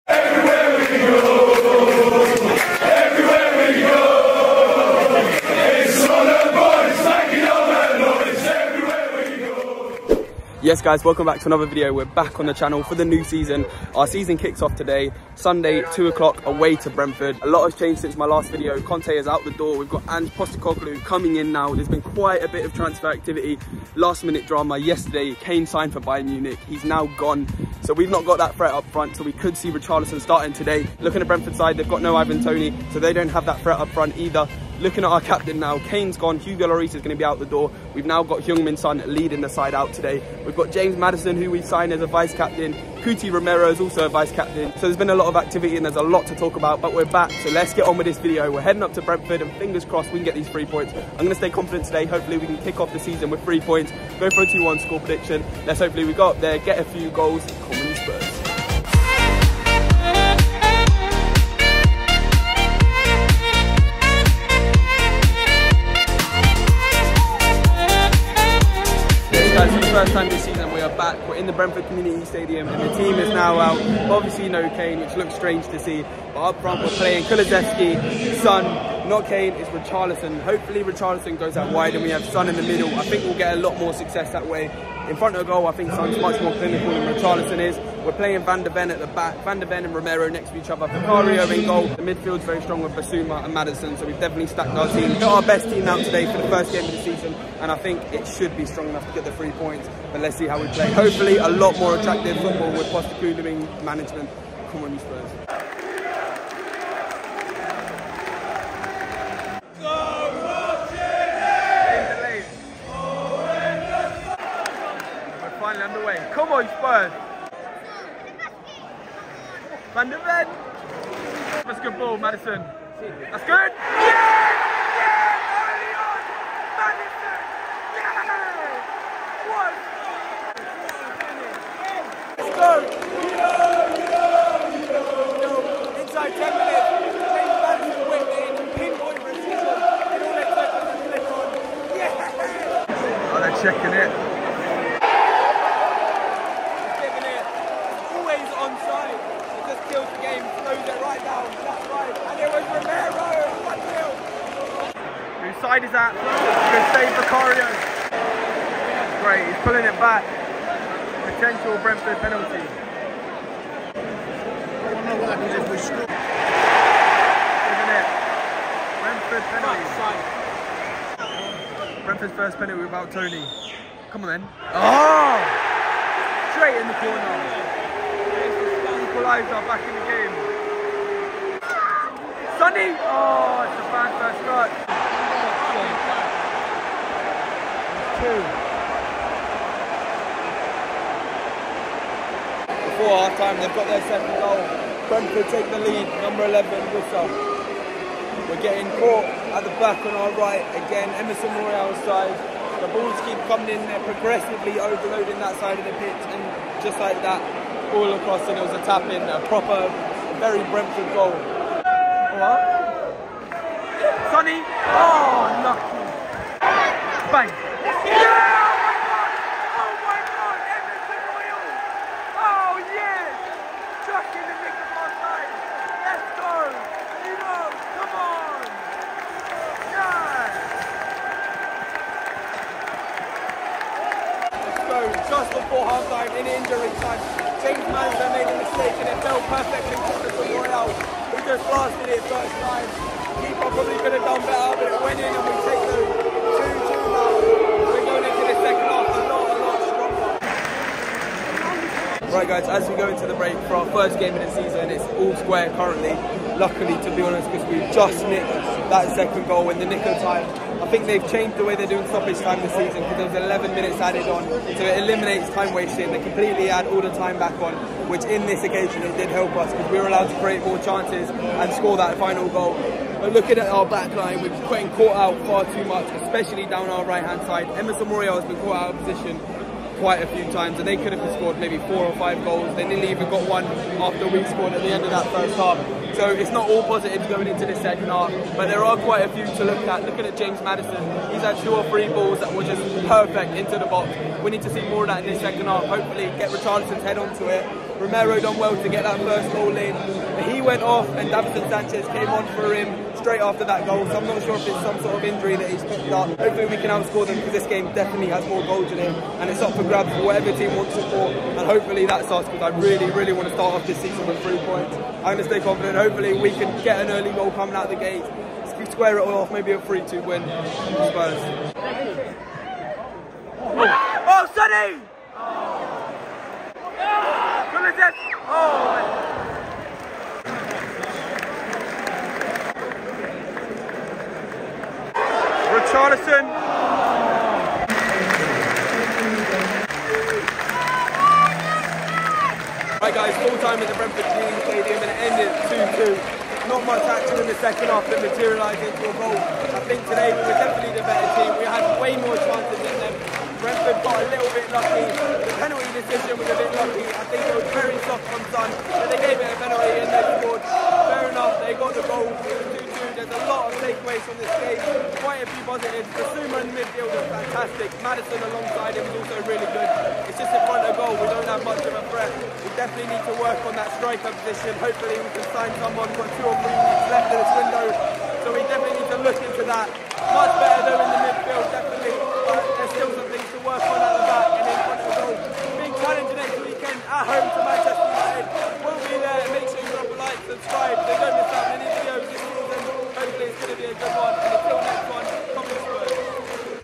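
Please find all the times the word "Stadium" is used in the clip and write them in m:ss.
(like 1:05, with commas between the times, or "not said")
1:12, 5:44.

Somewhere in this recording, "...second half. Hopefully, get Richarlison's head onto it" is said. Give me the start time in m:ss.
4:55.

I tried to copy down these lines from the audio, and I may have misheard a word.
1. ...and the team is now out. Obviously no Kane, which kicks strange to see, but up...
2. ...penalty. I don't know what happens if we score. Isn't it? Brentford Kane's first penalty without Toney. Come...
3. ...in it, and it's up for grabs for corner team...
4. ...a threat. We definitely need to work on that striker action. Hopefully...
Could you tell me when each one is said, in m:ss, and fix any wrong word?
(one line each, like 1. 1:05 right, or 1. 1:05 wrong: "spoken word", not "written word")
1. 1:12 wrong: "looks", not "kicks"
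2. 2:42 wrong: "Brentford", not "Kane"
3. 5:08 wrong: "whatever", not "corner"
4. 6:11 wrong: "position", not "action".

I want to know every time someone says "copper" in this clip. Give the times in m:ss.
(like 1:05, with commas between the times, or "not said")
not said.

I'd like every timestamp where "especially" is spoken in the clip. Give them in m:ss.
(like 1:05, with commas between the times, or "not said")
4:36.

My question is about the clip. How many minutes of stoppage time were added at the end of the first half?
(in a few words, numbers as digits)
11.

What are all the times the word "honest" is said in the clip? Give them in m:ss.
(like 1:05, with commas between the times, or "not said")
4:17.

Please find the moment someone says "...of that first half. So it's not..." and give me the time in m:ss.
4:45.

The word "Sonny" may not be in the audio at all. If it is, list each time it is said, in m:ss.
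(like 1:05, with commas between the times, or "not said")
3:02, 3:34, 5:24.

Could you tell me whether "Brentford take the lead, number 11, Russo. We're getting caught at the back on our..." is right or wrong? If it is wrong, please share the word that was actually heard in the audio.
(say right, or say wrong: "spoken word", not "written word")
right.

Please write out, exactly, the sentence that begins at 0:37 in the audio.
We've now got Heung-Min Son leading the side out today.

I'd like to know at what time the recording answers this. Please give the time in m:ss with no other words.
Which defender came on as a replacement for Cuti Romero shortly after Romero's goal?
5:01.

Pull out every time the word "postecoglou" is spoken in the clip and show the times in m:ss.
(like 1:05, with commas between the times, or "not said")
0:20, 1:42.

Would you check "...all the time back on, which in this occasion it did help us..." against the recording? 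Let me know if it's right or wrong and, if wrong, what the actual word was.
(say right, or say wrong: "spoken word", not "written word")
right.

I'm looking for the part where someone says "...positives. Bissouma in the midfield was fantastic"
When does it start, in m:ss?
6:05.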